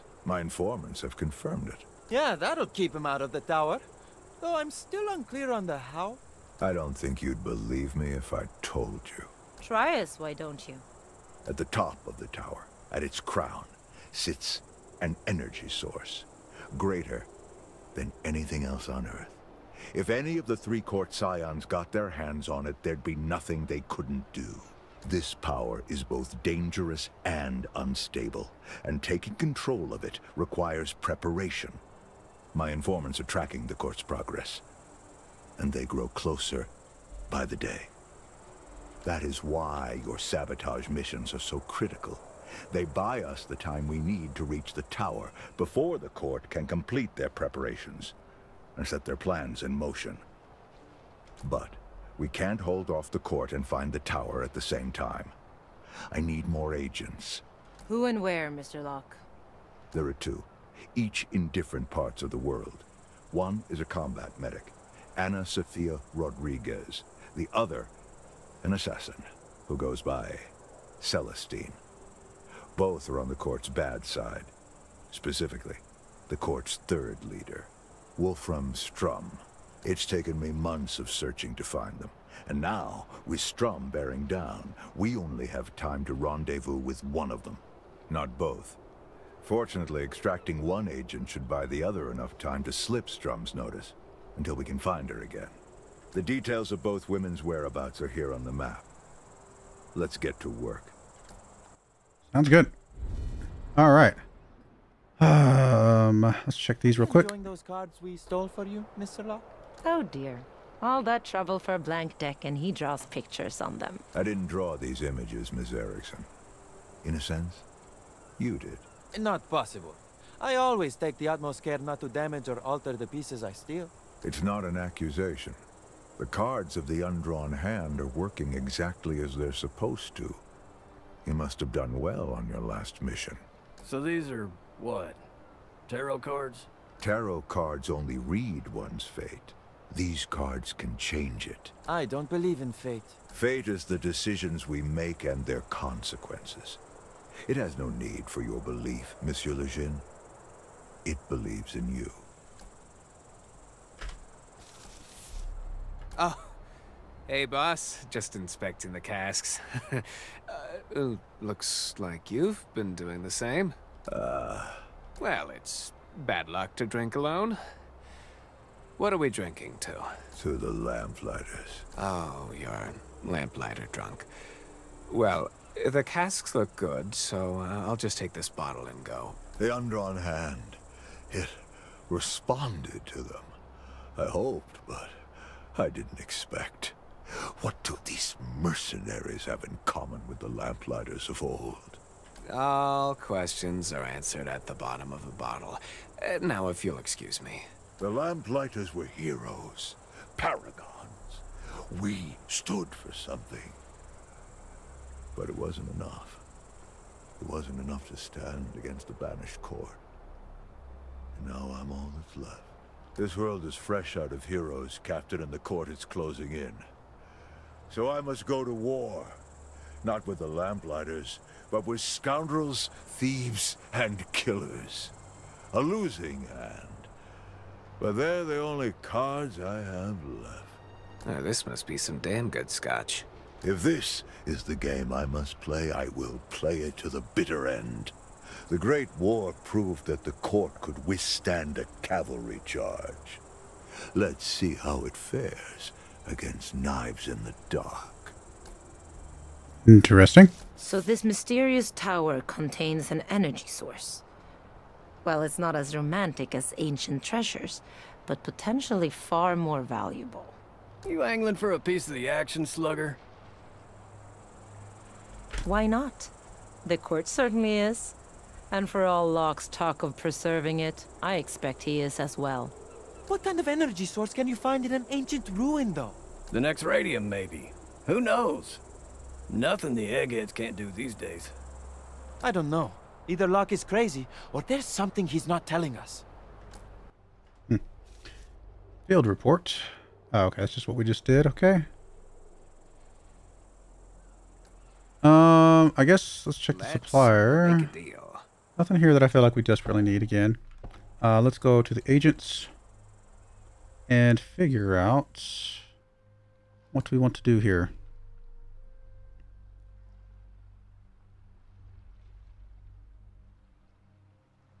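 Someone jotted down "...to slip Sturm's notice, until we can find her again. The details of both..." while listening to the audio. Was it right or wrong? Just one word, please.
right.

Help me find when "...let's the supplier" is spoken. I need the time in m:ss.
4:56.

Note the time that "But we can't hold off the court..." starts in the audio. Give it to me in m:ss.
0:51.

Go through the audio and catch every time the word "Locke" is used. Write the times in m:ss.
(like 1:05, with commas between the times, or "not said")
0:58, 1:49, 4:29, 4:43.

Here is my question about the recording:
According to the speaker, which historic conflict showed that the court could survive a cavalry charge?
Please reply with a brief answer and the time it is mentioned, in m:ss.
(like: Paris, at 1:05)
The Great War, at 3:58.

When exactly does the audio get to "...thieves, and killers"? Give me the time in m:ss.
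3:43.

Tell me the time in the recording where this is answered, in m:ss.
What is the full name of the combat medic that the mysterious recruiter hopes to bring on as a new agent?
1:05.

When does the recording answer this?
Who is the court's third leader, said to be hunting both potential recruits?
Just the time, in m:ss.
1:18.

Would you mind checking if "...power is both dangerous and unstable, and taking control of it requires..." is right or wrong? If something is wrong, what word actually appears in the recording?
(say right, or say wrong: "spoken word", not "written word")
right.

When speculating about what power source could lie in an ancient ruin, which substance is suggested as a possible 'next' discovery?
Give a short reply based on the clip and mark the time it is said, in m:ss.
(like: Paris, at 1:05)
Radium, at 4:36.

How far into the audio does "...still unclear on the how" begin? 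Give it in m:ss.
0:04.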